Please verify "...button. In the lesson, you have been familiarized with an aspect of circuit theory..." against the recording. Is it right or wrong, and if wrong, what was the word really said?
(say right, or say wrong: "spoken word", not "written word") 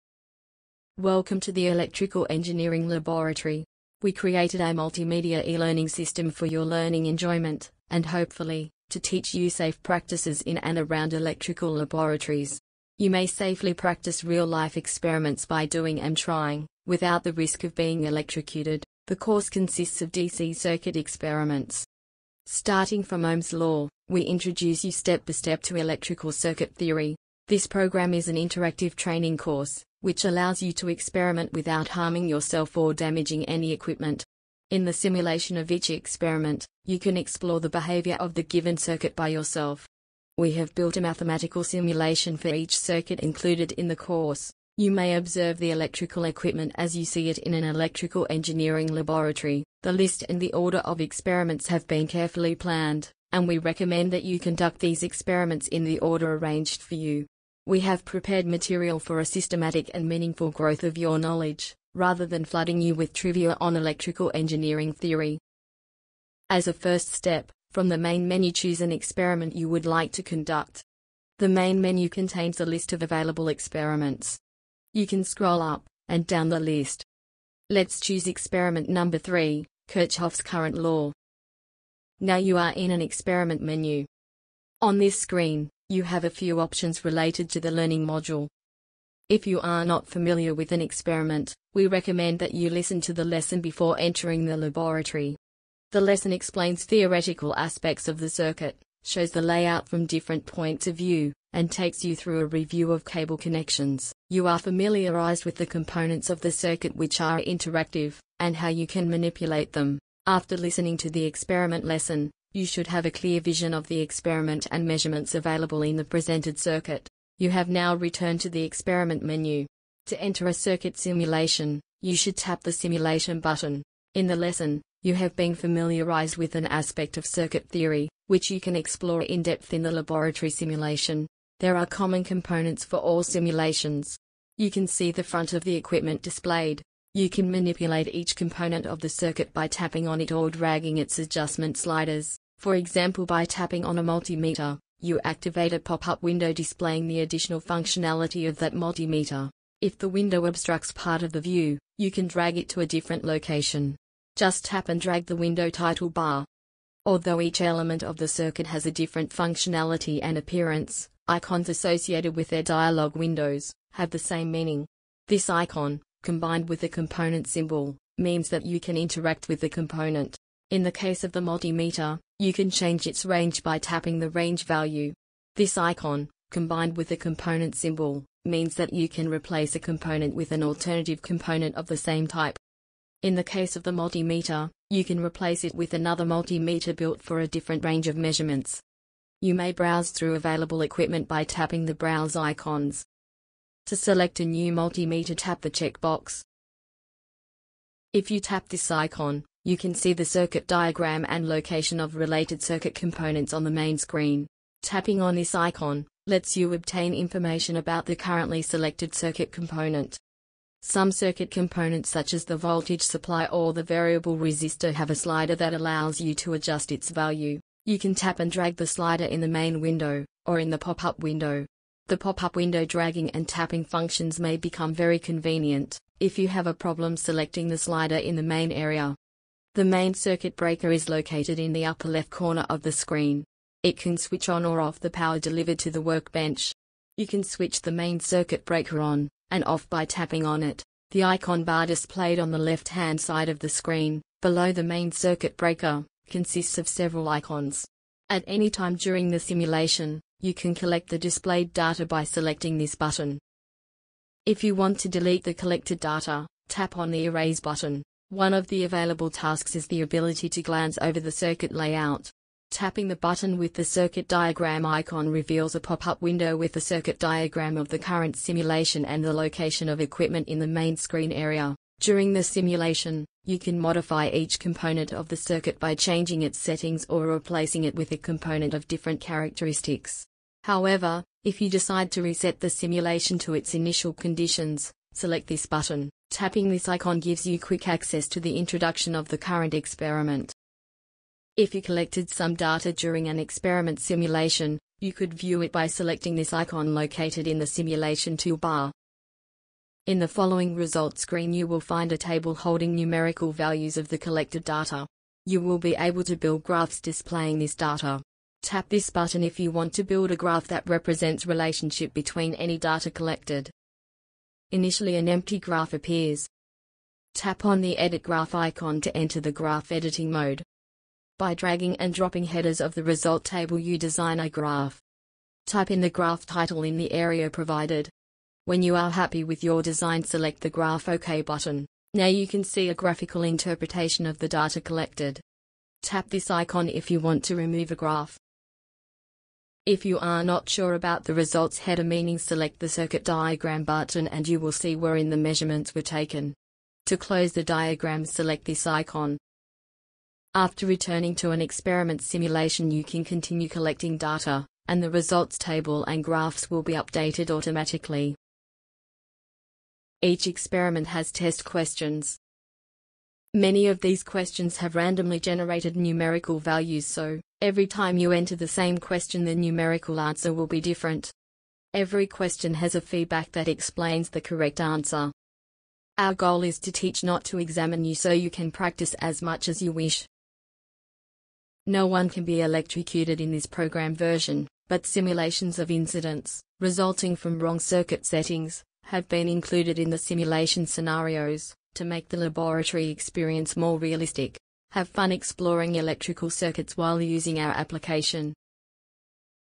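right.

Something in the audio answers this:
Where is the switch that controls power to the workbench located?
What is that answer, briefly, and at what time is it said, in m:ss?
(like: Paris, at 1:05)
Upper left corner, at 3:51.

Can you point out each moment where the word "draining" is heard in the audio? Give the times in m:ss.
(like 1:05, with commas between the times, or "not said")
not said.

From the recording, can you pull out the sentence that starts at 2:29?
If the window obstructs part of the view, you can drag it to a different location.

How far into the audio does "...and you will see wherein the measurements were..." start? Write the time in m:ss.
5:44.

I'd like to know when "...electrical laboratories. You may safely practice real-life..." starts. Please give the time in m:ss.
0:11.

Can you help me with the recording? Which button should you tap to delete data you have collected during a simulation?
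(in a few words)
Erase.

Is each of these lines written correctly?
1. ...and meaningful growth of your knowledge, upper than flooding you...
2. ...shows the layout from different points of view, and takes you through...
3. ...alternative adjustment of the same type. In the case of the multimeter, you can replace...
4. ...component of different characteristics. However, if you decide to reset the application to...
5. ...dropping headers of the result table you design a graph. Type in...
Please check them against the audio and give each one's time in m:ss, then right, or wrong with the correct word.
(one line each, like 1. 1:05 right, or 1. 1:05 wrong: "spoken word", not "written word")
1. 0:59 wrong: "rather", not "upper"
2. 1:39 right
3. 3:00 wrong: "component", not "adjustment"
4. 4:38 wrong: "simulation", not "application"
5. 5:22 right.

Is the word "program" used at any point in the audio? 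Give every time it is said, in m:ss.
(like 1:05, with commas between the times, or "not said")
0:27, 6:23.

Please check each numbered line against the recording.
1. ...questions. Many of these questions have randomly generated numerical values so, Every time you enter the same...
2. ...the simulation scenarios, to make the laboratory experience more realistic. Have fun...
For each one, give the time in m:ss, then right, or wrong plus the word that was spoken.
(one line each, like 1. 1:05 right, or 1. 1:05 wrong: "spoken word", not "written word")
1. 6:01 right
2. 6:30 right.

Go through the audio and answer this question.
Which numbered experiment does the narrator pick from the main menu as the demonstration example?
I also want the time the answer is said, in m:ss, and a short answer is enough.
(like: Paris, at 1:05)
3, at 1:18.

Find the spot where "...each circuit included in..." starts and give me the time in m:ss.
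0:42.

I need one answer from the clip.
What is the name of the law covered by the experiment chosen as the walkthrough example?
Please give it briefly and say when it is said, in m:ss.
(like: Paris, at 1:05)
Kirchhoff's current law, at 1:19.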